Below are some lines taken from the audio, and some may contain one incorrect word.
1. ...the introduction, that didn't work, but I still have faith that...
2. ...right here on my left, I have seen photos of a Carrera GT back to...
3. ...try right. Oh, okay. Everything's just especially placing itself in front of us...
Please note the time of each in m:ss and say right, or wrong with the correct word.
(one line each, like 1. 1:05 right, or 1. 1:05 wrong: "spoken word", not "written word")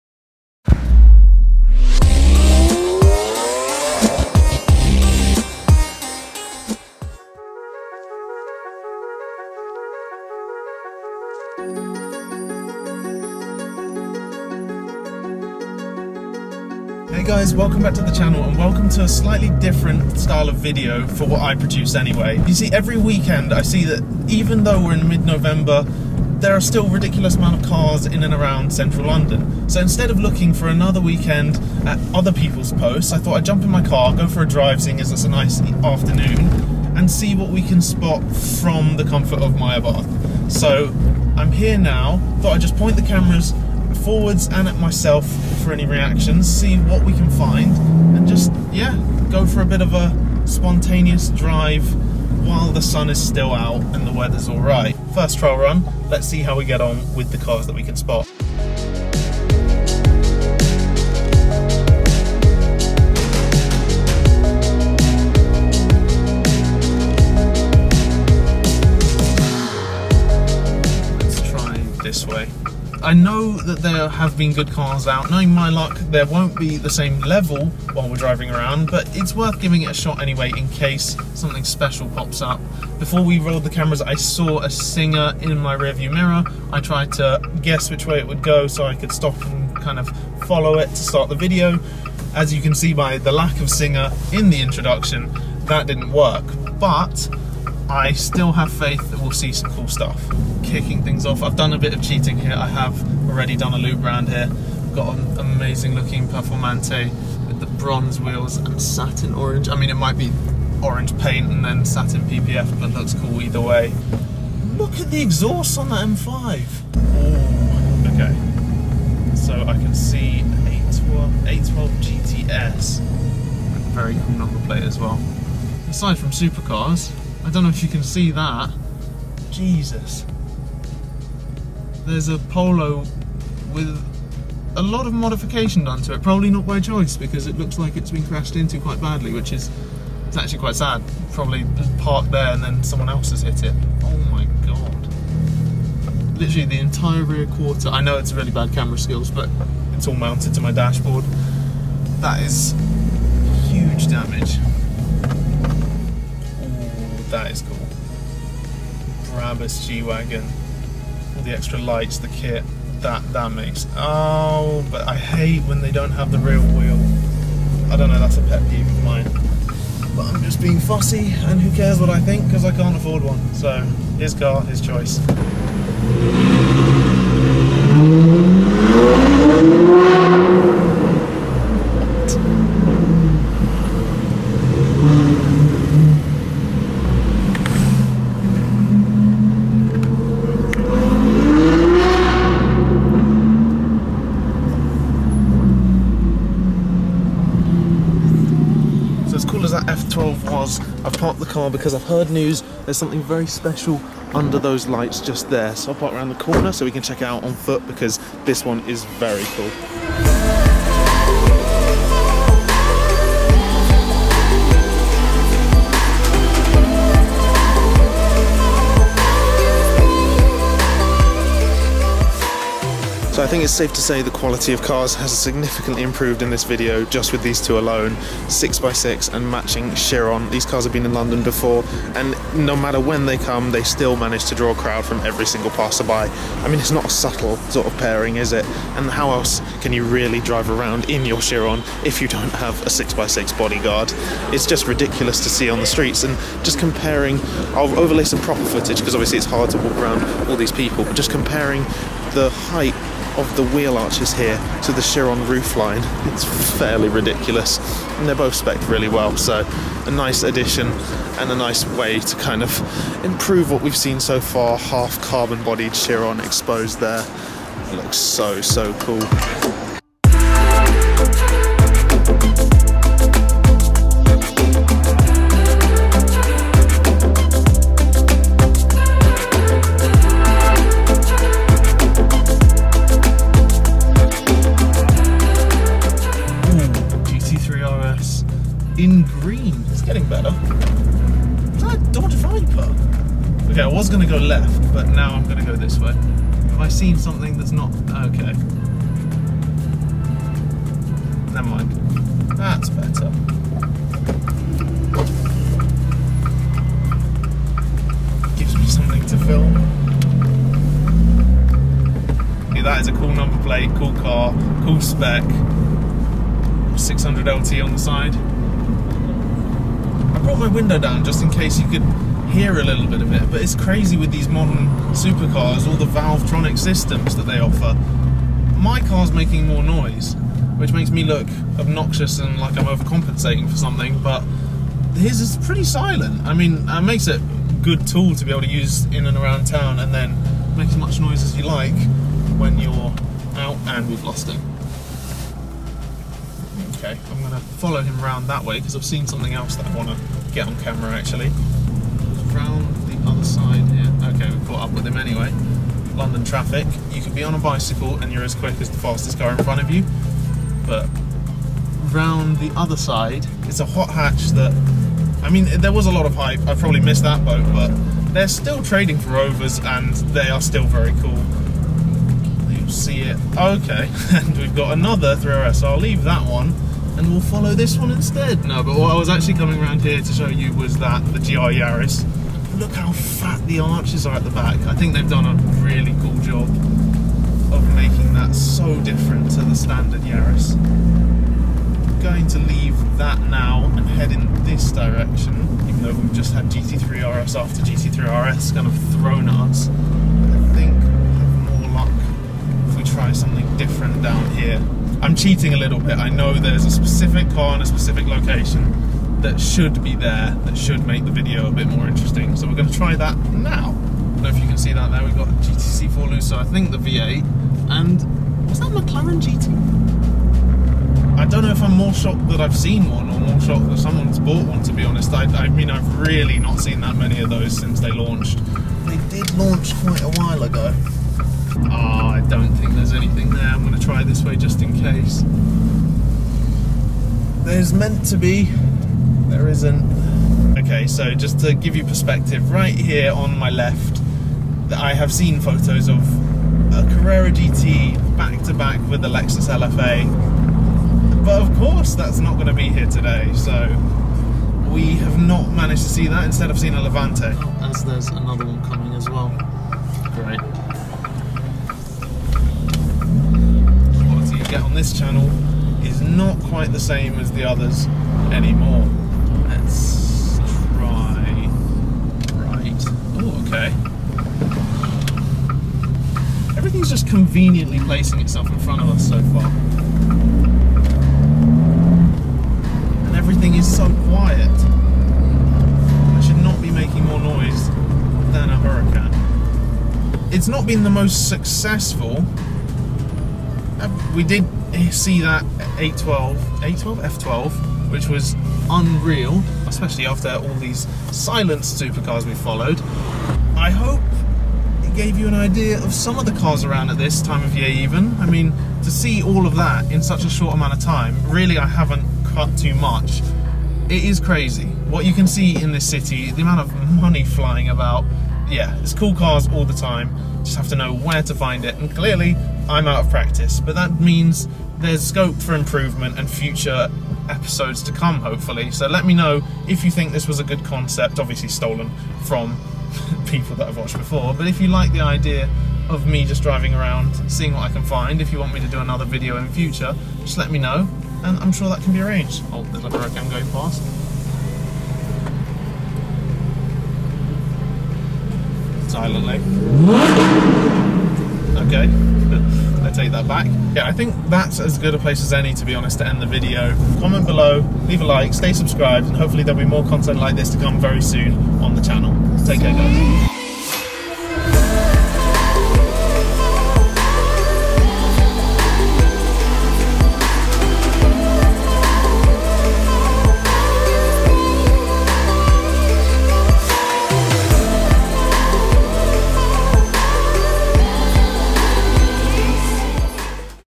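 1. 1:34 right
2. 7:22 right
3. 7:50 wrong: "conveniently", not "especially".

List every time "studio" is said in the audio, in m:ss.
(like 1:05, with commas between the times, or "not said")
not said.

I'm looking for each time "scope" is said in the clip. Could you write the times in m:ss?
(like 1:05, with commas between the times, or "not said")
8:45.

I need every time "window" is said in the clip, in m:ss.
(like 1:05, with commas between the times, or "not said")
5:20.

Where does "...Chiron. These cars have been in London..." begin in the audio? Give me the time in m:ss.
3:49.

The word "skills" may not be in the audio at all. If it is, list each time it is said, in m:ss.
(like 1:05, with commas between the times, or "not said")
2:28.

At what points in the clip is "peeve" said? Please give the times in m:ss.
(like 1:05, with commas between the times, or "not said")
2:48.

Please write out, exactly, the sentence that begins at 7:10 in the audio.
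Oh, I don't think there's anything there.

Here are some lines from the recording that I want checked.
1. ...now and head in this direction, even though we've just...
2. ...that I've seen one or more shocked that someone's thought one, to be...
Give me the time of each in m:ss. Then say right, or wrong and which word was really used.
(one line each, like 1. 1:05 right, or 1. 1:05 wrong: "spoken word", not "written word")
1. 6:33 right
2. 7:02 wrong: "bought", not "thought".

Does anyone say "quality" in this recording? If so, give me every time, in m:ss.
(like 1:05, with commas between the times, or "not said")
3:44, 7:44.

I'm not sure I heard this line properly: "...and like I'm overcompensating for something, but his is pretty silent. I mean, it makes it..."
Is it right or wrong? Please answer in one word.
right.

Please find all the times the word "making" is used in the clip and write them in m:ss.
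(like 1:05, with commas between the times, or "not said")
5:29, 6:27, 8:06.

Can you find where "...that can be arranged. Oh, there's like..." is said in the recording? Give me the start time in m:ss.
9:01.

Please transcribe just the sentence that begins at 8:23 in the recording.
I hope it gave you an idea of some of the cars around at this time of year even.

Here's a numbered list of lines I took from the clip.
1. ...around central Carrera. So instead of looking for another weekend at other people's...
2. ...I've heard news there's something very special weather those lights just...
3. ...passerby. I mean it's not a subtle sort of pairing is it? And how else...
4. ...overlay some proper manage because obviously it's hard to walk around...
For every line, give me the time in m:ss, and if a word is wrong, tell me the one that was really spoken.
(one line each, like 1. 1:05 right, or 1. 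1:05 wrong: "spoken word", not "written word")
1. 0:28 wrong: "London", not "Carrera"
2. 3:21 wrong: "under", not "weather"
3. 3:55 right
4. 4:07 wrong: "footage", not "manage".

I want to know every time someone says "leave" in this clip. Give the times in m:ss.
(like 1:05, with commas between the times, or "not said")
6:15, 6:32, 9:18.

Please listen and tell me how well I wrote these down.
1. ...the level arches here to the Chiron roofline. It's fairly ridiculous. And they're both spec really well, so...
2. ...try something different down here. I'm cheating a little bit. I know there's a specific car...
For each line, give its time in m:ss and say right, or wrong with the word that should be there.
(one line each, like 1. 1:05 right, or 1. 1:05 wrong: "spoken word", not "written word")
1. 4:13 wrong: "wheel", not "level"
2. 6:43 right.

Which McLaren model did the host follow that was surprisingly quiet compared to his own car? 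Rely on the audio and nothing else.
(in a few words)
600LT.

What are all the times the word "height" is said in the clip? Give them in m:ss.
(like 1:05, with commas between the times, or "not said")
4:12.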